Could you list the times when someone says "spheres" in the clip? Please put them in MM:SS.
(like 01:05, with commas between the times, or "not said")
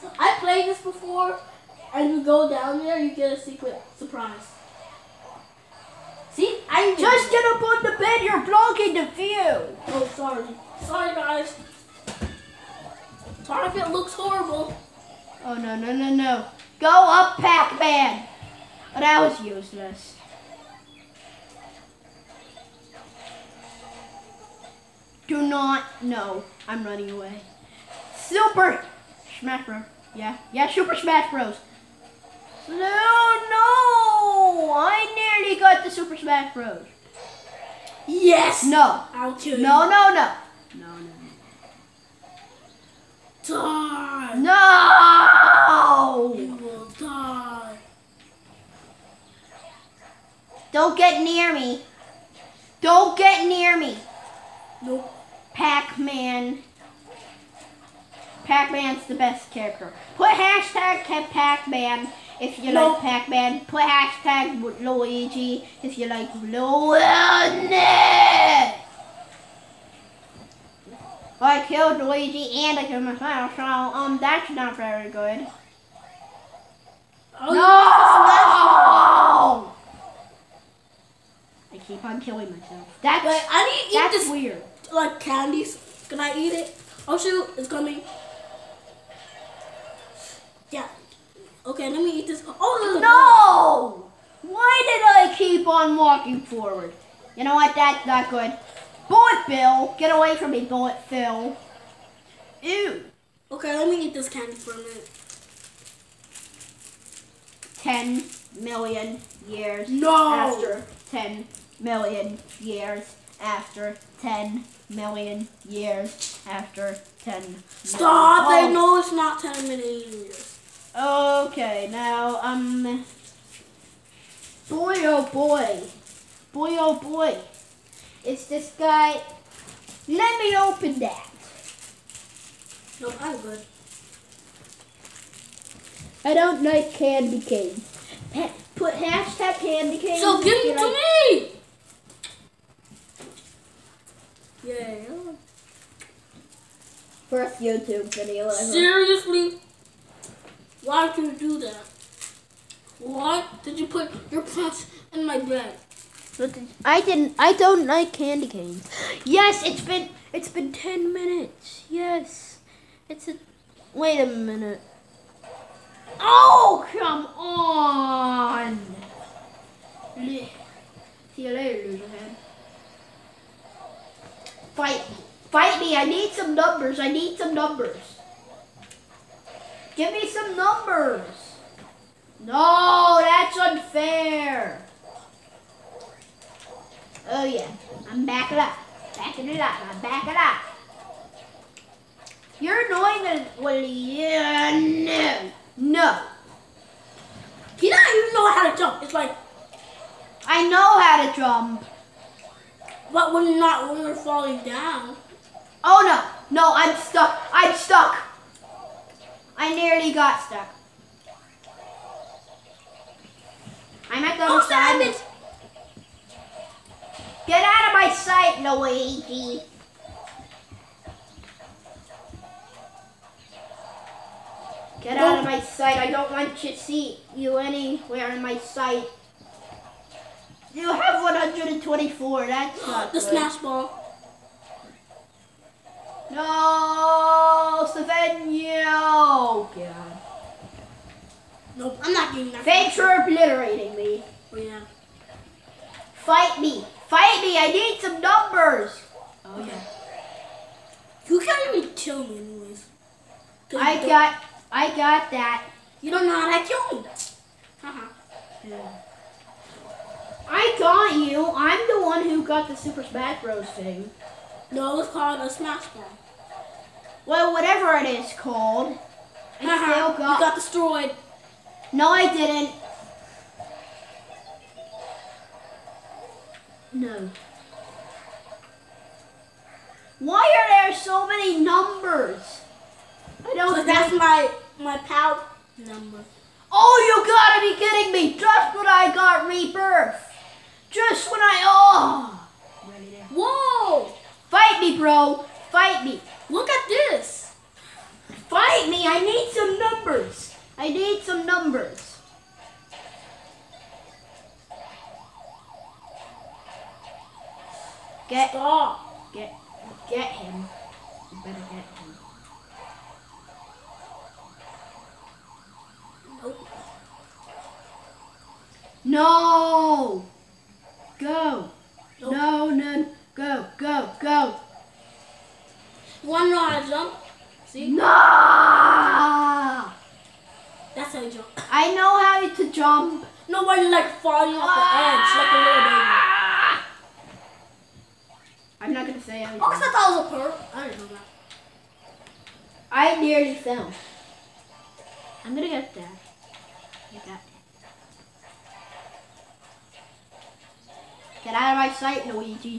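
not said.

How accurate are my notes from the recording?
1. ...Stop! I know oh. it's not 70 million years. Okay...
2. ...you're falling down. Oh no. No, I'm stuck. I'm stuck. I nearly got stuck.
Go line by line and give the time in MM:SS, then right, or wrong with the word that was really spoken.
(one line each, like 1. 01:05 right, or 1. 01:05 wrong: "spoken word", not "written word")
1. 01:57 wrong: "10", not "70"
2. 03:24 right.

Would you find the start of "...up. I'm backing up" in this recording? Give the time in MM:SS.
03:09.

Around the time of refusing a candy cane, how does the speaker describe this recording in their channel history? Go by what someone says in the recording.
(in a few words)
first YouTube video ever.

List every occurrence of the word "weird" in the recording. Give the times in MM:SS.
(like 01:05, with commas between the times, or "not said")
01:24.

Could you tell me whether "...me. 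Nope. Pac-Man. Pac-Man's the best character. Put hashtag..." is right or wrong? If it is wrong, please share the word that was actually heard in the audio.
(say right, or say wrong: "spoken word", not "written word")
right.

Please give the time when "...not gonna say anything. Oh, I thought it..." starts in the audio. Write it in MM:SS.
05:38.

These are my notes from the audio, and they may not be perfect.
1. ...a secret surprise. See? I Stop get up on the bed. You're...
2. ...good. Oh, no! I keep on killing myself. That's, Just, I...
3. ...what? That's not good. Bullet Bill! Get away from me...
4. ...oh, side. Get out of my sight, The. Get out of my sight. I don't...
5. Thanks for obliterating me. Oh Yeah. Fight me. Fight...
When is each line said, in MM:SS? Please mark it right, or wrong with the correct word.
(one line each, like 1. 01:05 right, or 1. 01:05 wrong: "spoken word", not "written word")
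1. 00:03 wrong: "Just", not "Stop"
2. 01:15 wrong: "Wait", not "Just"
3. 01:37 right
4. 03:34 wrong: "Luigi", not "The"
5. 04:02 right.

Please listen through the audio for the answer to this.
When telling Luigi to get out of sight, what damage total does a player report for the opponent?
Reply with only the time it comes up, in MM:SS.
03:51.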